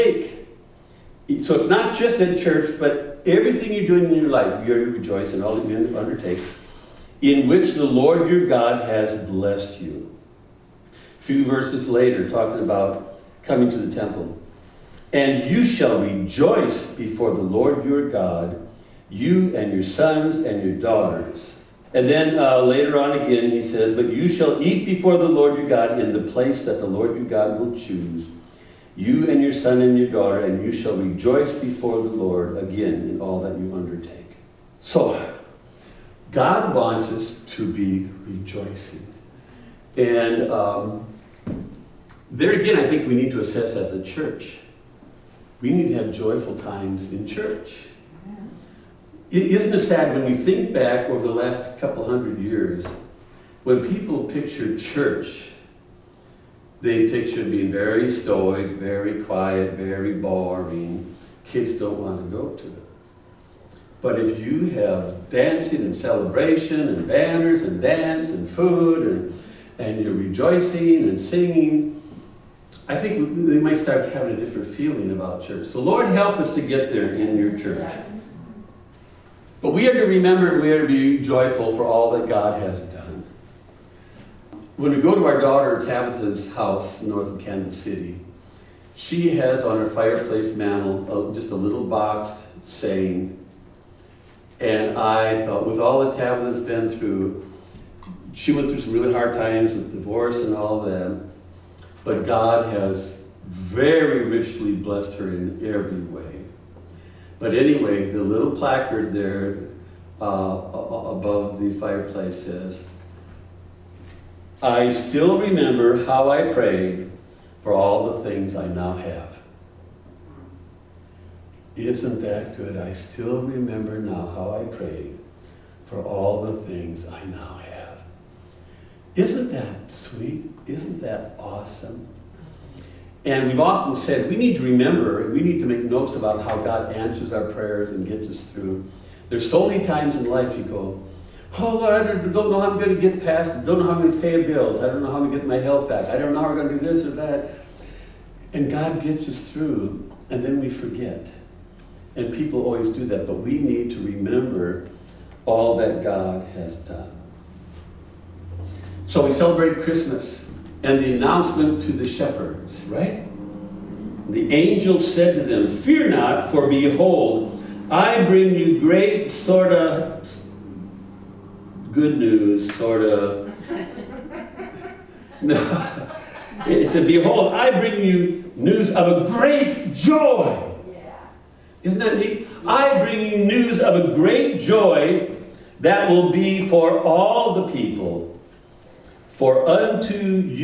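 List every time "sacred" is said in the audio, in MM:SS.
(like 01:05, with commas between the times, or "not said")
not said.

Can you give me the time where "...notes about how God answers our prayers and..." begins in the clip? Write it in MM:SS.
02:15.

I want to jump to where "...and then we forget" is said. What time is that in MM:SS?
02:30.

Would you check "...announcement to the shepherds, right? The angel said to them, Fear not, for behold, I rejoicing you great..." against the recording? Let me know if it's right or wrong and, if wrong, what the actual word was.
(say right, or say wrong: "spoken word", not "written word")
wrong: "bring", not "rejoicing".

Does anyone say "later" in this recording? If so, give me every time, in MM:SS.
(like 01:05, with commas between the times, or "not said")
00:11, 00:22.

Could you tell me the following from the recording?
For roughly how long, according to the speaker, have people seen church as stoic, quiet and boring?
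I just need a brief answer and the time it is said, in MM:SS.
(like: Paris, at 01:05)
last couple hundred years, at 00:51.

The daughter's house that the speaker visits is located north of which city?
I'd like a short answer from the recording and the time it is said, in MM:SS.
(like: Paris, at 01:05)
Kansas City, at 01:27.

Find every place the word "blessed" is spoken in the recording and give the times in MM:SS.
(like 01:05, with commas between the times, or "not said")
00:09, 01:44.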